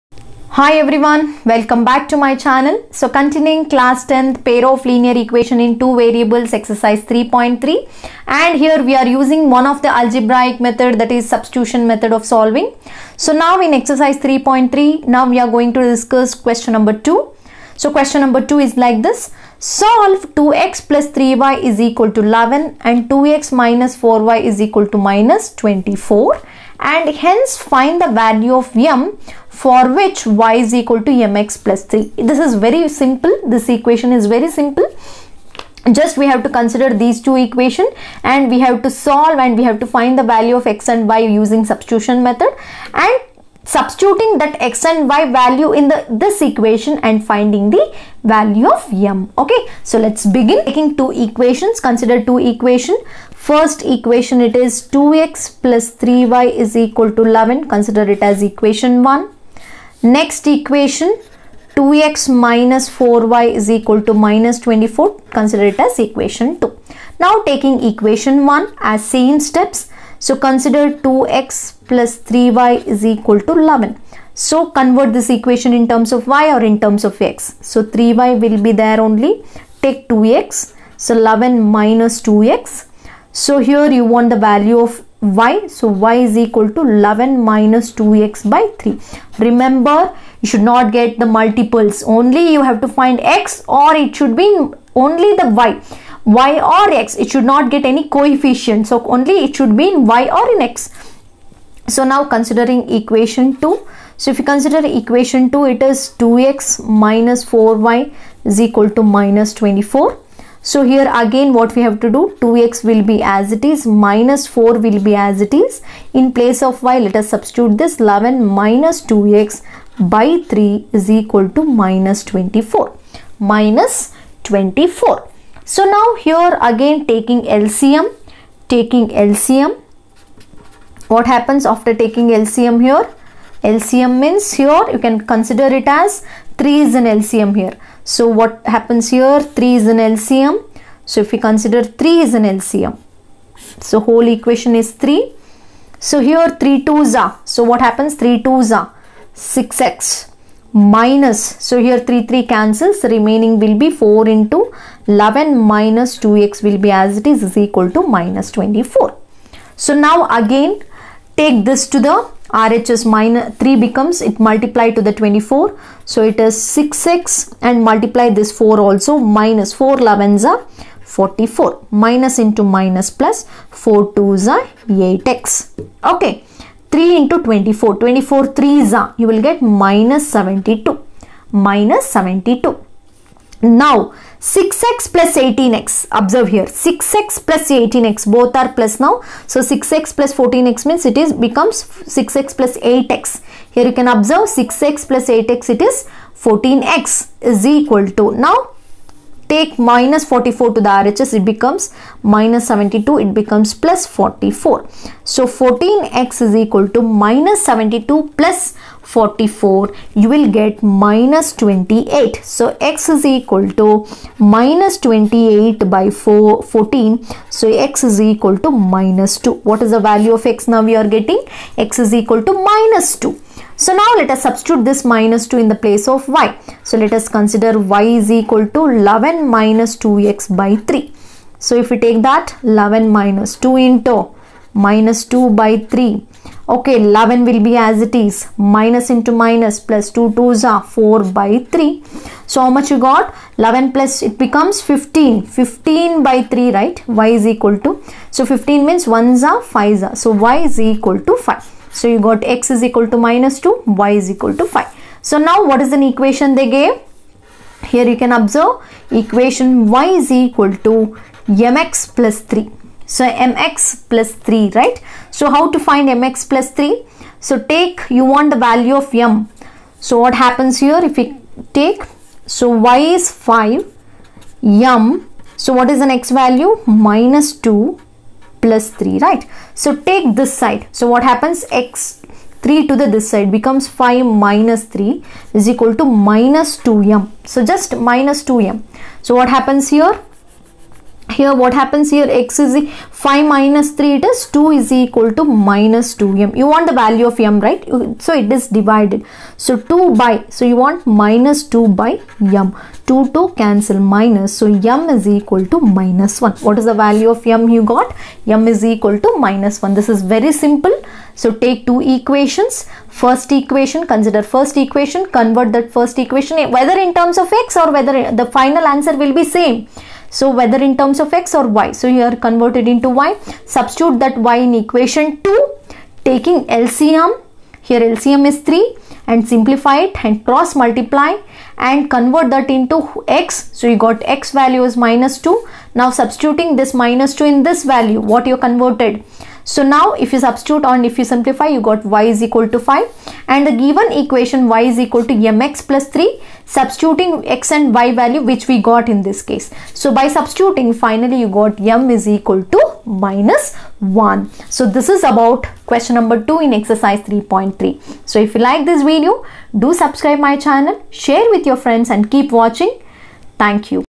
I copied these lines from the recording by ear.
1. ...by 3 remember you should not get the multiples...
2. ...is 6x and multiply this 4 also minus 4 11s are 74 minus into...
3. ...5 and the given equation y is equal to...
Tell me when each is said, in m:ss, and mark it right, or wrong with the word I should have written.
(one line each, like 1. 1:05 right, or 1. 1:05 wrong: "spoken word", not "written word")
1. 1:28 right
2. 2:46 wrong: "44", not "74"
3. 5:42 right.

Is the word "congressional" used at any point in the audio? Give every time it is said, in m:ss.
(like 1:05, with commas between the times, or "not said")
not said.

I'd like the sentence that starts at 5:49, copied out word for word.
So by substituting finally you got m is equal to minus 1.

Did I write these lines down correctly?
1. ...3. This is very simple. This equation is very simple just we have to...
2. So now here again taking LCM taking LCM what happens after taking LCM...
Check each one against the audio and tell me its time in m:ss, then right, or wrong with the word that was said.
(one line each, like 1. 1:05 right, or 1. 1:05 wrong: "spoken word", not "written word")
1. 0:31 right
2. 2:05 right.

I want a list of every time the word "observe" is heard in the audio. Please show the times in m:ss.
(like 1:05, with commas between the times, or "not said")
3:06, 3:14, 4:18.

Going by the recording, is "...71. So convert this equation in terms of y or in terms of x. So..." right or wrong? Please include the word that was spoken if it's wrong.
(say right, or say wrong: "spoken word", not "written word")
wrong: "11", not "71".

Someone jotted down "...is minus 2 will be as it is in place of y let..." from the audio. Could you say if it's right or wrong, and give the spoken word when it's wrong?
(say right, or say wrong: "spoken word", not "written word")
wrong: "4", not "2".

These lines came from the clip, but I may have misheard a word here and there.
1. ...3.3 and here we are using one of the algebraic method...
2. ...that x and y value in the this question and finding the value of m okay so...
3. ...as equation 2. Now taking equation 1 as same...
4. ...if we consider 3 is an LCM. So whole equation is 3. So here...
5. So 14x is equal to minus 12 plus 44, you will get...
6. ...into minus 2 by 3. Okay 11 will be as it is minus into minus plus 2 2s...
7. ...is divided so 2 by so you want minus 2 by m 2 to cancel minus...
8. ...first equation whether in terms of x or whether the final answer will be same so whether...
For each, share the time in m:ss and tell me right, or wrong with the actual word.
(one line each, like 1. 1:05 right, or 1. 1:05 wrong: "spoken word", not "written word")
1. 0:07 right
2. 0:44 wrong: "equation", not "question"
3. 1:05 right
4. 2:21 right
5. 3:25 wrong: "72", not "12"
6. 3:53 right
7. 4:58 right
8. 5:15 right.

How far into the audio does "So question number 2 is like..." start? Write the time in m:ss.
0:17.